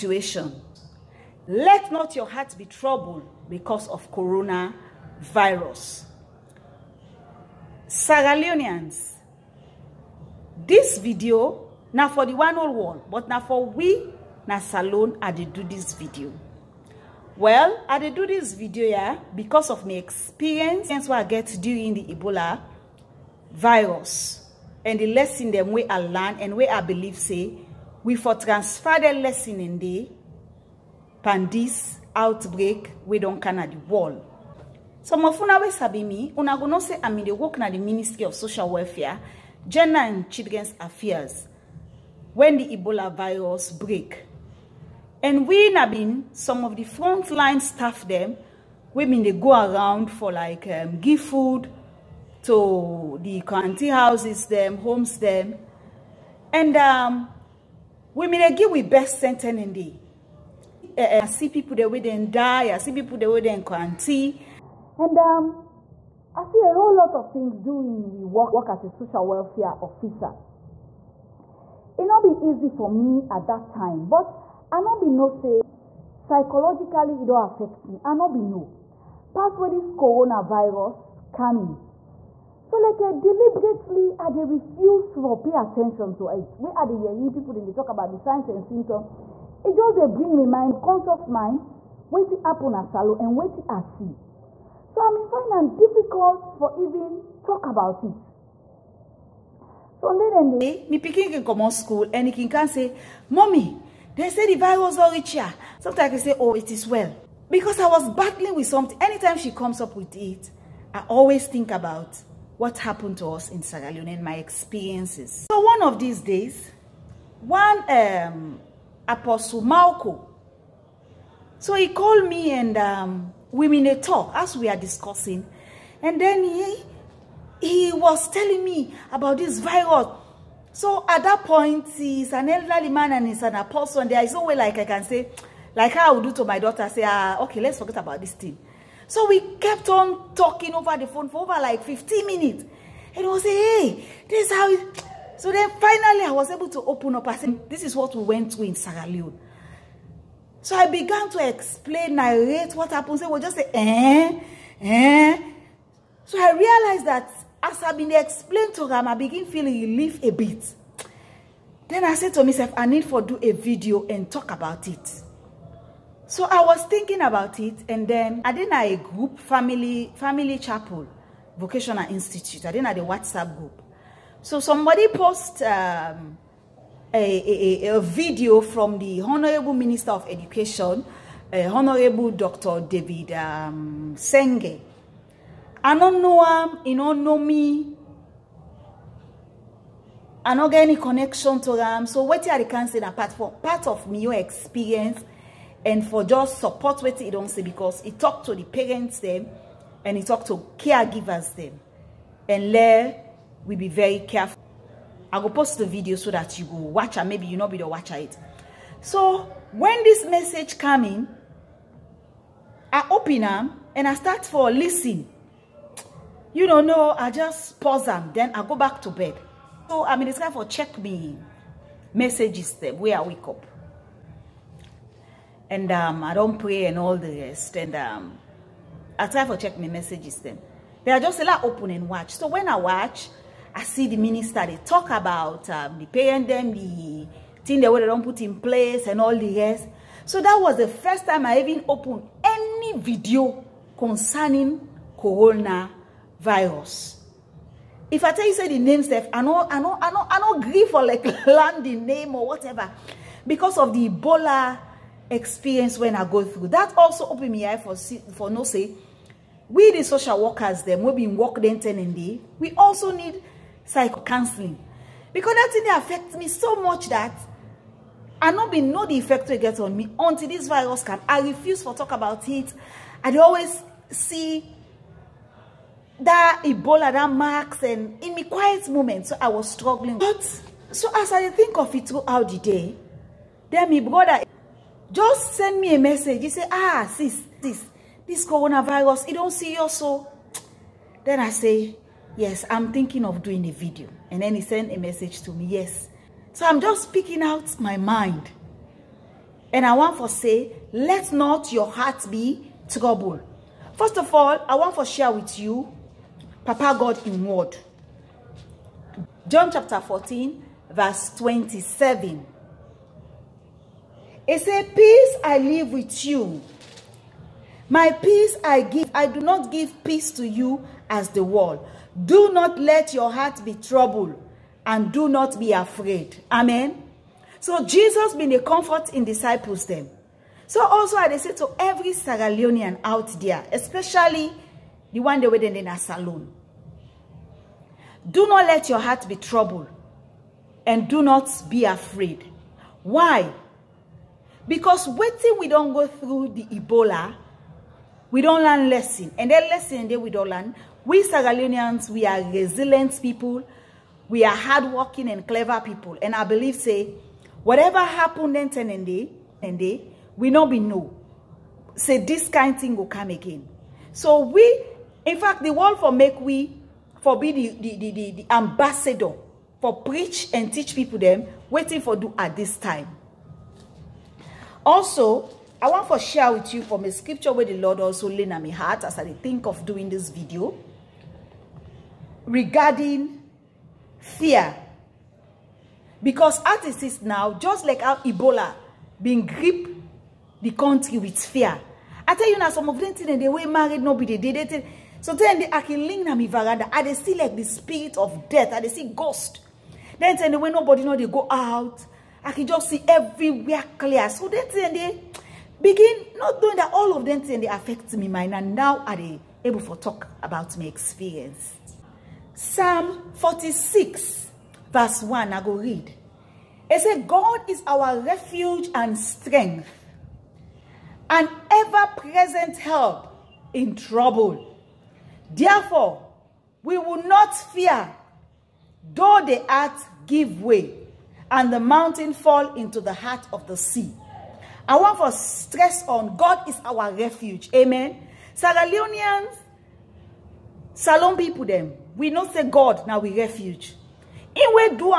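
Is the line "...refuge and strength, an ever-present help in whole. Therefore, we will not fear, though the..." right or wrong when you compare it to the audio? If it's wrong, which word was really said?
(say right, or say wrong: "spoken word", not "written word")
wrong: "trouble", not "whole".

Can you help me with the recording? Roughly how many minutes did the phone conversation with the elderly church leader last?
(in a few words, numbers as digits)
15 minutes.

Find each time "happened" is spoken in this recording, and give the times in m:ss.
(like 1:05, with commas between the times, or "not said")
1:52, 2:32, 5:57.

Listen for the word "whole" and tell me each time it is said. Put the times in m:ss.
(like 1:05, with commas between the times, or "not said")
1:06.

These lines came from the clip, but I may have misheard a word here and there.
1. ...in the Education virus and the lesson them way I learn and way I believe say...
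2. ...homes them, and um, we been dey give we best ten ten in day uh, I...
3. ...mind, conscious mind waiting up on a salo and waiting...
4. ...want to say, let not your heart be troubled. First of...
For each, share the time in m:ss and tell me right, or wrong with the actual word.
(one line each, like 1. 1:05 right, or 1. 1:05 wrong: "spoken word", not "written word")
1. 0:21 wrong: "Ebola", not "Education"
2. 0:54 right
3. 1:30 right
4. 4:59 right.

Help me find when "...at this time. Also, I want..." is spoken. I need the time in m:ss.
6:12.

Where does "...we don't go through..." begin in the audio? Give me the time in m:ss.
5:45.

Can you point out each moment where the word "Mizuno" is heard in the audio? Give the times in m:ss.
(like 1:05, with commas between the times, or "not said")
not said.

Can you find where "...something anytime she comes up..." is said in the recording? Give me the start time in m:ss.
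1:48.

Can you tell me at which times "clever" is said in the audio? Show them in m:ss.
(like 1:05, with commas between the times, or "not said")
5:55.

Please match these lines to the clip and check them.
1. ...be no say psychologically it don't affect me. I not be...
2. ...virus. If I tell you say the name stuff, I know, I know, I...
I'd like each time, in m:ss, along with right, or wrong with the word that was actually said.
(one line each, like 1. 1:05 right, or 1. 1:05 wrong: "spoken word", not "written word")
1. 1:15 right
2. 4:05 wrong: "coronavirus", not "virus".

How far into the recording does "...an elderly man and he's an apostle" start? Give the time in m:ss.
2:12.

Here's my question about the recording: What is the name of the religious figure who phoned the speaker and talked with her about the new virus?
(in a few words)
Apostle Malco.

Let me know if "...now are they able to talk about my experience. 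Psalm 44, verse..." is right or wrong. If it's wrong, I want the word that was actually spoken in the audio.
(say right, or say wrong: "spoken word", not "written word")
wrong: "46", not "44".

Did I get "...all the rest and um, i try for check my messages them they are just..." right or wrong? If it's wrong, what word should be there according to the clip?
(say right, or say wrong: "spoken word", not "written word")
right.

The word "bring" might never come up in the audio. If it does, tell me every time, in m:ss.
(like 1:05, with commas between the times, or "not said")
1:30.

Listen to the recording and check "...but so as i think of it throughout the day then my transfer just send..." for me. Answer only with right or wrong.
wrong.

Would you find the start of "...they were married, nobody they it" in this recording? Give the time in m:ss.
6:33.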